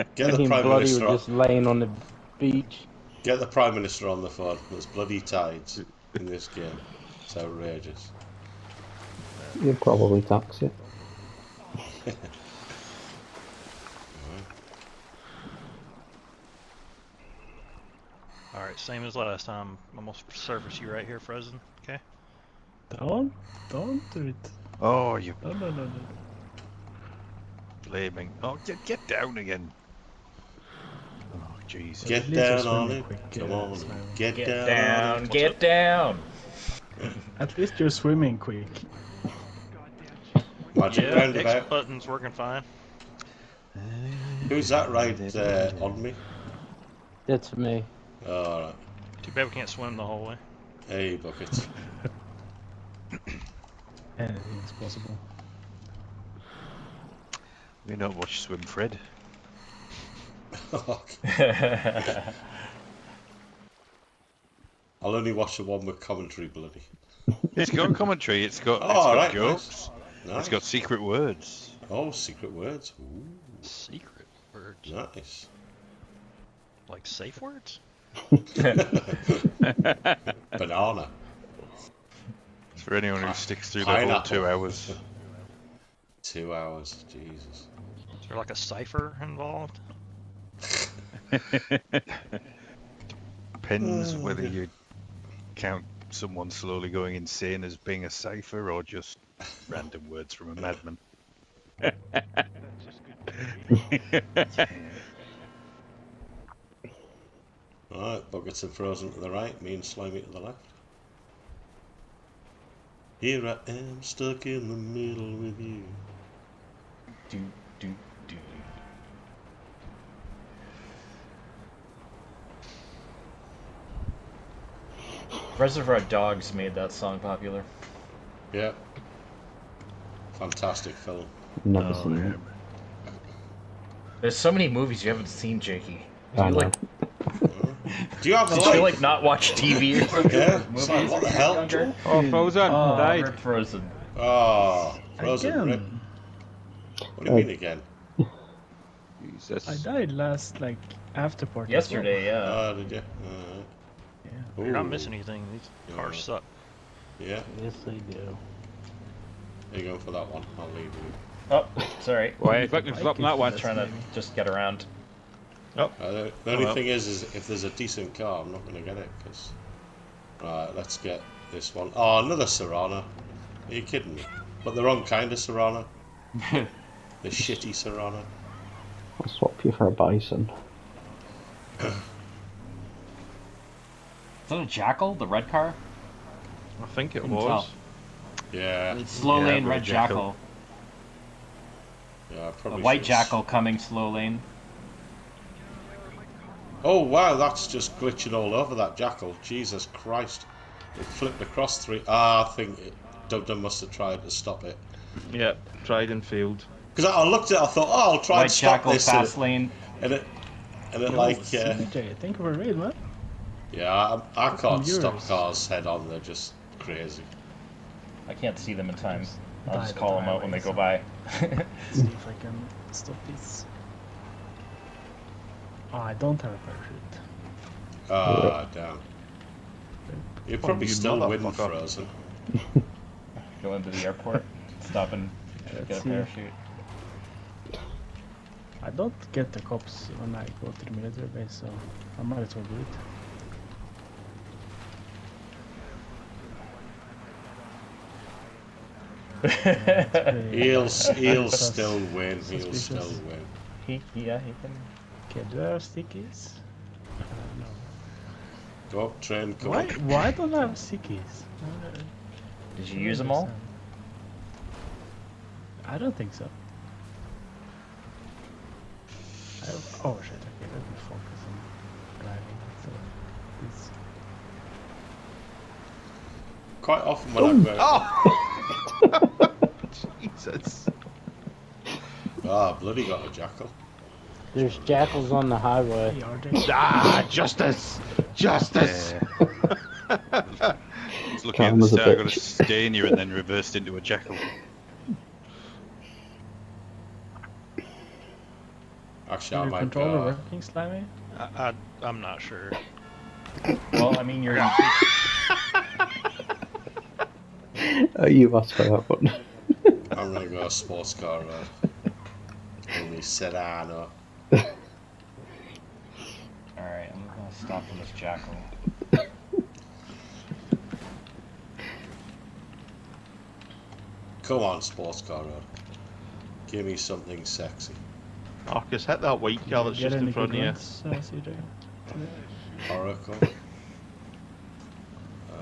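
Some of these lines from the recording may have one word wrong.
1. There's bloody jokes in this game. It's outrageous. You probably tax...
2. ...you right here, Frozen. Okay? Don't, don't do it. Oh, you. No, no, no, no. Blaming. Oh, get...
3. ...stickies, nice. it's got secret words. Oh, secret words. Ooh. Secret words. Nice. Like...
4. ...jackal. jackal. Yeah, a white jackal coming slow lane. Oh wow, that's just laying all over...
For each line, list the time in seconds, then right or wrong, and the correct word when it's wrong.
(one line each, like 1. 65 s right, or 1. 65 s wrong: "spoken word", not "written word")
1. 4 s wrong: "tides", not "jokes"
2. 20 s right
3. 69 s wrong: "jokes", not "stickies"
4. 189 s wrong: "glitching", not "laying".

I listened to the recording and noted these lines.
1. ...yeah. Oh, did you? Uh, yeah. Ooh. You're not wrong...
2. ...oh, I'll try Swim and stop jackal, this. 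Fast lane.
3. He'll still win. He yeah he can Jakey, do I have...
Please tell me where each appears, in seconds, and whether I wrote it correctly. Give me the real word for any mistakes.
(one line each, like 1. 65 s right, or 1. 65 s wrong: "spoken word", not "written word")
1. 152 s wrong: "missing", not "wrong"
2. 207 s wrong: "White", not "Swim"
3. 252 s wrong: "Okay", not "Jakey".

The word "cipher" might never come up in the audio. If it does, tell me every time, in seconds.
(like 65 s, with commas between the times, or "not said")
88 s, 98 s.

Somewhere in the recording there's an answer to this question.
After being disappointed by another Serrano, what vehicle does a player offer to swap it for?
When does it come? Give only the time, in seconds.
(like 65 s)
179 s.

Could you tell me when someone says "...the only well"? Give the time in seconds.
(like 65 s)
166 s.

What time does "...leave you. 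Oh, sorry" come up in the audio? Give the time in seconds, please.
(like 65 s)
160 s.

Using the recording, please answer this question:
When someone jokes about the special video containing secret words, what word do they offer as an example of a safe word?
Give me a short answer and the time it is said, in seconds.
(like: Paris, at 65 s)
Banana, at 80 s.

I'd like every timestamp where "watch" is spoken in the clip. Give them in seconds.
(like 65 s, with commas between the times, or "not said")
40 s, 58 s, 65 s, 139 s.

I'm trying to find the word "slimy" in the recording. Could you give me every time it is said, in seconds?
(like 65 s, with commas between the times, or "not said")
109 s, 300 s.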